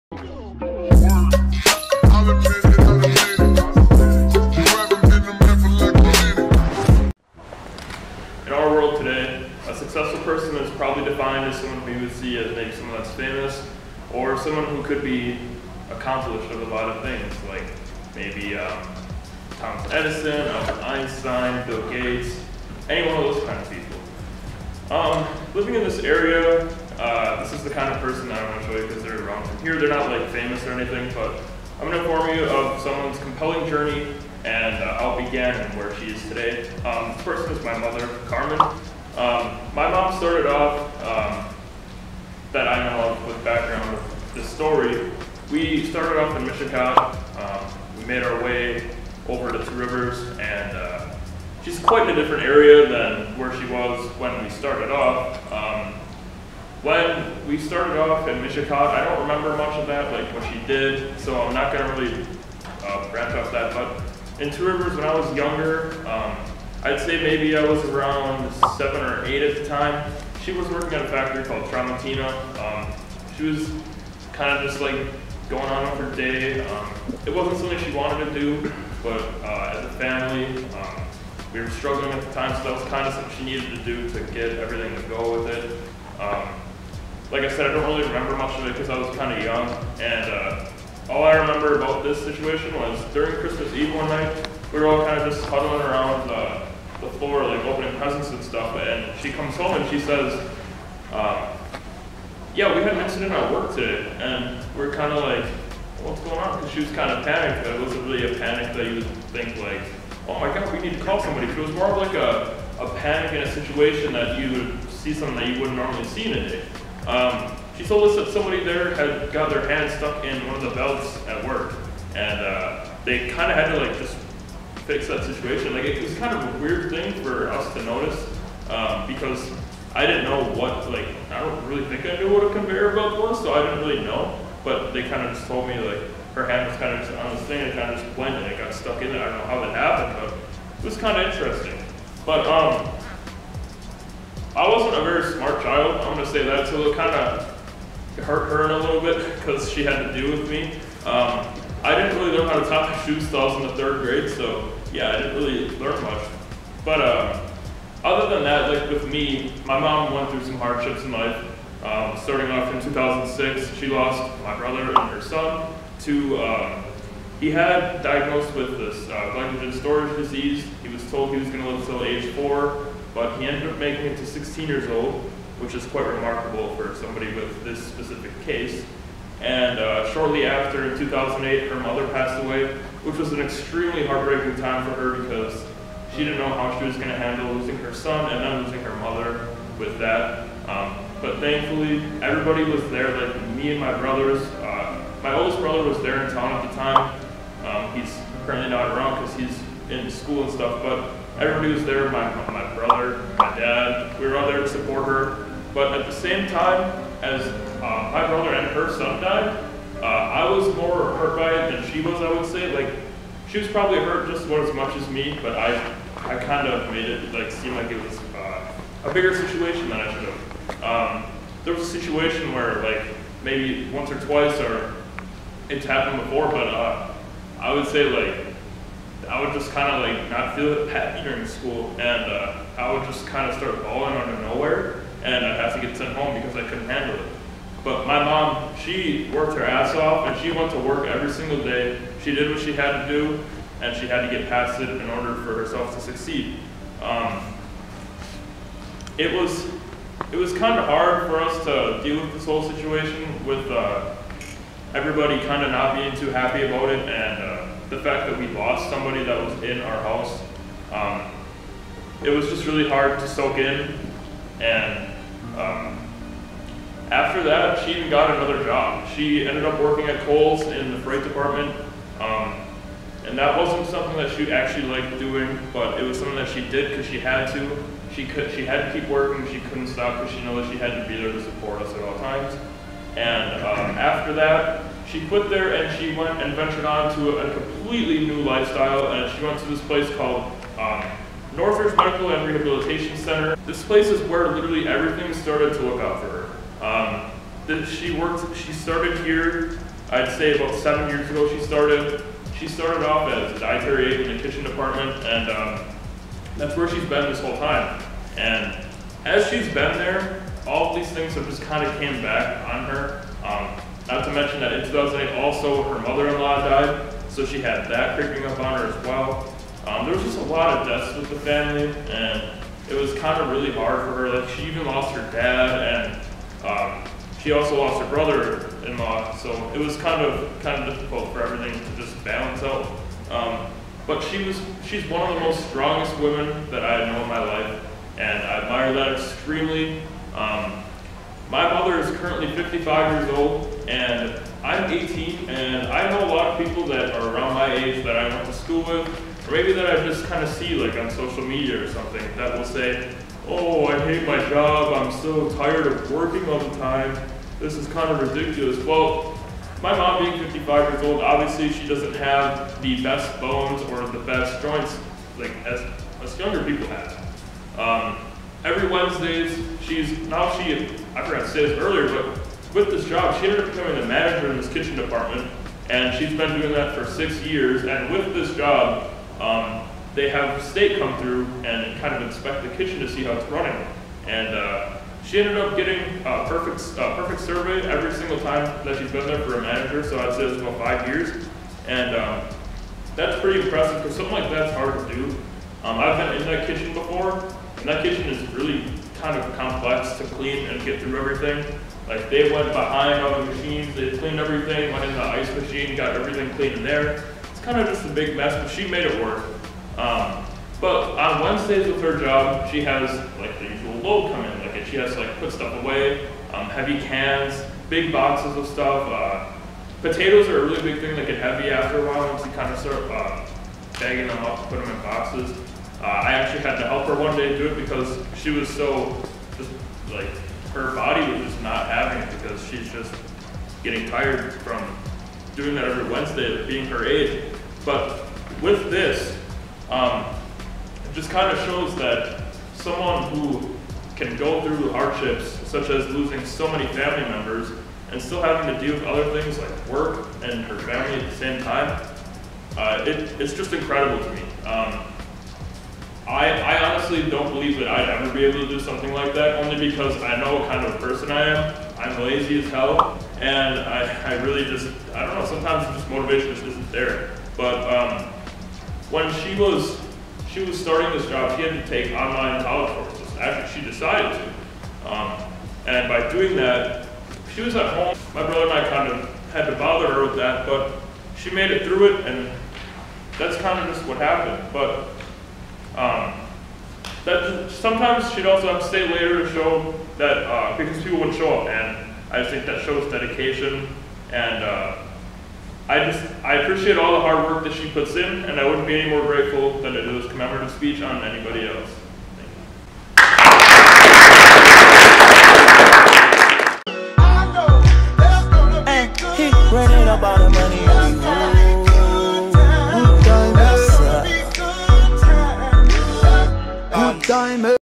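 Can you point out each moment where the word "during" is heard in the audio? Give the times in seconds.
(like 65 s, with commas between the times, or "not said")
93 s, 231 s.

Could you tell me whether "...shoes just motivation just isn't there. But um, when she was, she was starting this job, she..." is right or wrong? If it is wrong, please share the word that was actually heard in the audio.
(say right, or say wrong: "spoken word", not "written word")
wrong: "sometimes", not "shoes".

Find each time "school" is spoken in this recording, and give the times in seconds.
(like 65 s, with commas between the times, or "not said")
200 s, 231 s, 348 s.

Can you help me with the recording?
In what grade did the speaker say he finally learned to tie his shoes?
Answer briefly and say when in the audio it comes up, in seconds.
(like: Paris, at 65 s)
Third grade, at 153 s.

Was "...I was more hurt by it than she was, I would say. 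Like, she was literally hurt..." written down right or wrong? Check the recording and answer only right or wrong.
wrong.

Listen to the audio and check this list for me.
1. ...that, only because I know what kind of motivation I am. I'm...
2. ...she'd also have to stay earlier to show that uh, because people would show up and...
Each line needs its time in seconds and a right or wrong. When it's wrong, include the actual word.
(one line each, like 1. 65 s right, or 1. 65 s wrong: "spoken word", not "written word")
1. 459 s wrong: "person", not "motivation"
2. 488 s wrong: "later", not "earlier".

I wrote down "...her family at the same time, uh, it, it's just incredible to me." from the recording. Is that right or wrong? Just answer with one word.
right.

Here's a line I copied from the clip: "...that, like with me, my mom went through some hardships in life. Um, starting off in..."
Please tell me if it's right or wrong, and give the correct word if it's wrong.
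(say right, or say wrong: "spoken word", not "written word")
right.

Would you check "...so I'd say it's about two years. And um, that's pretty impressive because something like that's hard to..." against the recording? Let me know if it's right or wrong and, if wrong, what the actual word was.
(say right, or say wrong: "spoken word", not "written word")
wrong: "five", not "two".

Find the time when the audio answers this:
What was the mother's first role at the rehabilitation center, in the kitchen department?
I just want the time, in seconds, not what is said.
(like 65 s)
303 s.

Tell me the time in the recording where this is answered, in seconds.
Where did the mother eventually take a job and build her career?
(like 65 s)
291 s.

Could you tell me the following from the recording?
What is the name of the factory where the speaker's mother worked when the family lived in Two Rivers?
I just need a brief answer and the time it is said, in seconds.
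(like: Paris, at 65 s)
Tramontina, at 71 s.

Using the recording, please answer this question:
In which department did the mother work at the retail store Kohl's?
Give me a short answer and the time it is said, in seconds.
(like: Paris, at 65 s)
Freight department, at 270 s.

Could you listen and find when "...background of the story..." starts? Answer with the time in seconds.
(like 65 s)
43 s.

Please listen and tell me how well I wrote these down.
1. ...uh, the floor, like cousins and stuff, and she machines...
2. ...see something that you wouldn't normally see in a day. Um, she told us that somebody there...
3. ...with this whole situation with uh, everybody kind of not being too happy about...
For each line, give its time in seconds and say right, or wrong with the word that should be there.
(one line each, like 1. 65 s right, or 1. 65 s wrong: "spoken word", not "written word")
1. 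96 s wrong: "comes", not "machines"
2. 114 s right
3. 252 s right.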